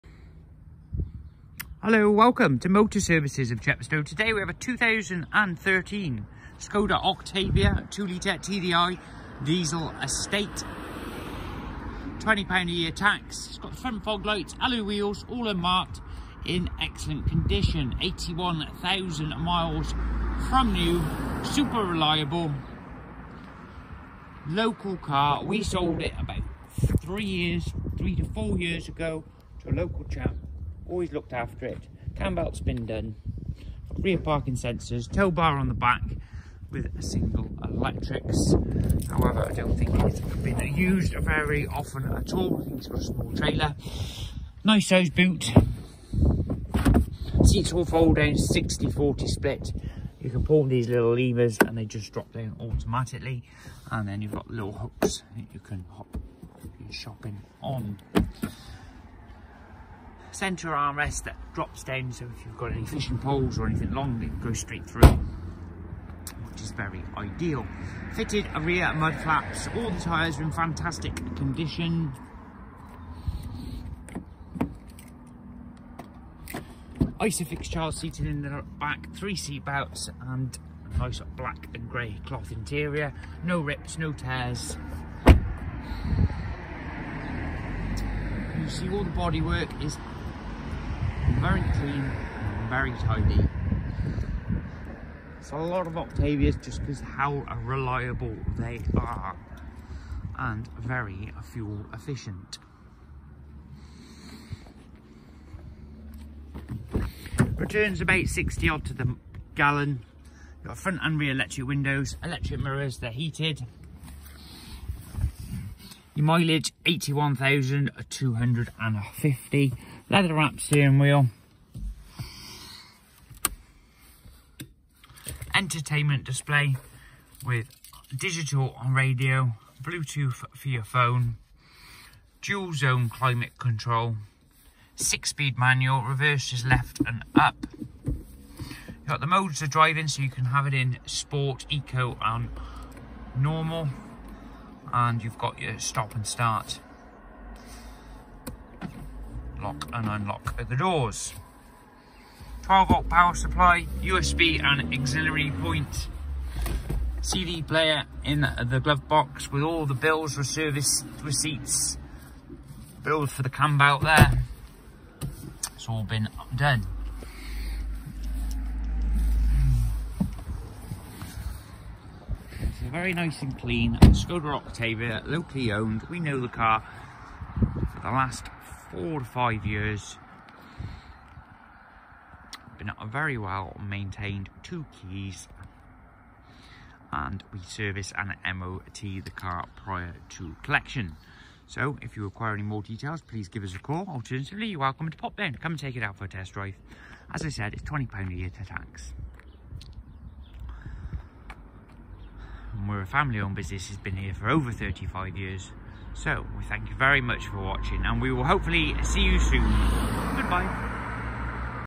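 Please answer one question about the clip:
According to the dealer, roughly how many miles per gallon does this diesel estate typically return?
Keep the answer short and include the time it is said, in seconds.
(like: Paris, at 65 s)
60, at 108 s.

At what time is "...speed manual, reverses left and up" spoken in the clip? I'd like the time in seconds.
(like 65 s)
135 s.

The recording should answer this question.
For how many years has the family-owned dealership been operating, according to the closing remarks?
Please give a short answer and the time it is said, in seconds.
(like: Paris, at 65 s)
over 35 years, at 204 s.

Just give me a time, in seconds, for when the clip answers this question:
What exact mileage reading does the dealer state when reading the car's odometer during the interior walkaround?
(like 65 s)
116 s.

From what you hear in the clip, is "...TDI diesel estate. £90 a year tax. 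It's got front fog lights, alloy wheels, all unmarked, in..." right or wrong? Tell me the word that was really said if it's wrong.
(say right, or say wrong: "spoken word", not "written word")
wrong: "20", not "90".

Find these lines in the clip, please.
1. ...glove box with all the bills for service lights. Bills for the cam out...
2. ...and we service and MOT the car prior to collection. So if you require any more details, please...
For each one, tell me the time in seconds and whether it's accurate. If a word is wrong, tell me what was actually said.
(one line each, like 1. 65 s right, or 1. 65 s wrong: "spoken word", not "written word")
1. 158 s wrong: "receipts", not "lights"
2. 187 s right.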